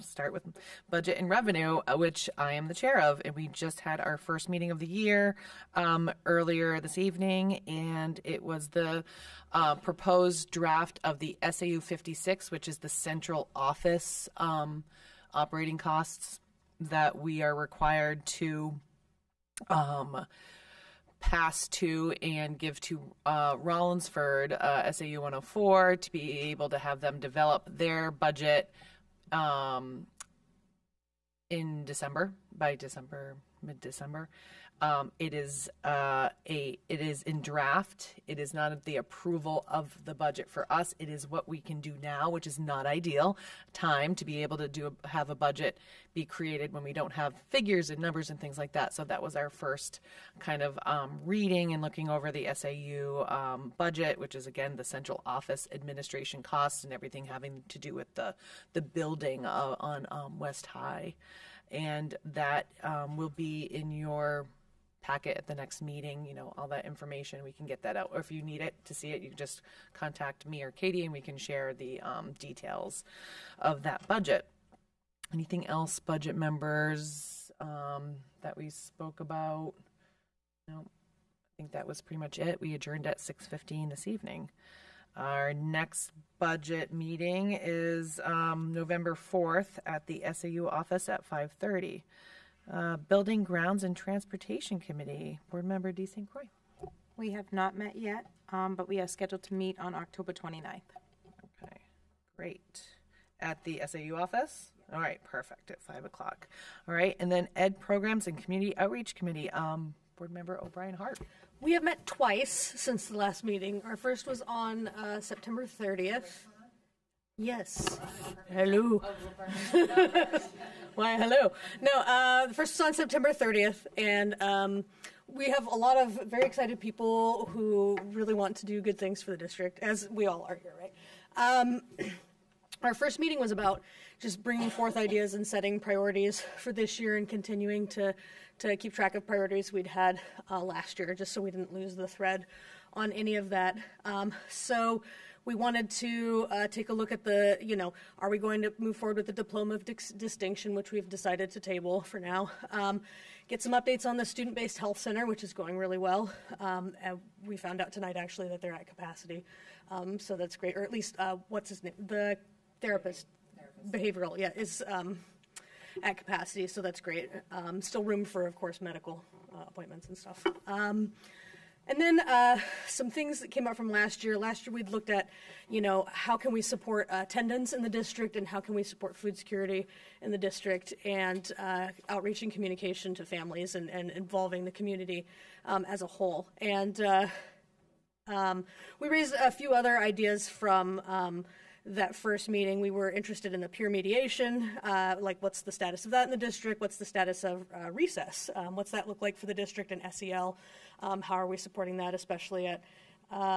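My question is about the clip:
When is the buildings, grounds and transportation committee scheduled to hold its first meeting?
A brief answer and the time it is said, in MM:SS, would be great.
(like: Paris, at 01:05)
October 29th, at 01:39.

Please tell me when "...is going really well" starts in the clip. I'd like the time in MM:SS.
02:35.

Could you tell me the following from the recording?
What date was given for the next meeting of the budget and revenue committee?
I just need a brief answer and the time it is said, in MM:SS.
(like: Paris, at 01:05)
November 4th, at 01:28.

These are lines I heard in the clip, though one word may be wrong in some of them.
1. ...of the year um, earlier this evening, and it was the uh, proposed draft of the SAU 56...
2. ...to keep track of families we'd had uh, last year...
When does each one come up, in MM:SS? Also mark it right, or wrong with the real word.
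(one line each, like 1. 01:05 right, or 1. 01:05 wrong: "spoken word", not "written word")
1. 00:04 right
2. 02:18 wrong: "priorities", not "families".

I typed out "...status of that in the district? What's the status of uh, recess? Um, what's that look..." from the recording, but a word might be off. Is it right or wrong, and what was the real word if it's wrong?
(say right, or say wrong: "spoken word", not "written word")
right.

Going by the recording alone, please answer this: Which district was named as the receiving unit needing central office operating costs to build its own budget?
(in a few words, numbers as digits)
SAU 104.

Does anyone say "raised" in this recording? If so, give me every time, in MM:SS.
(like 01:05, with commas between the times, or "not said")
03:09.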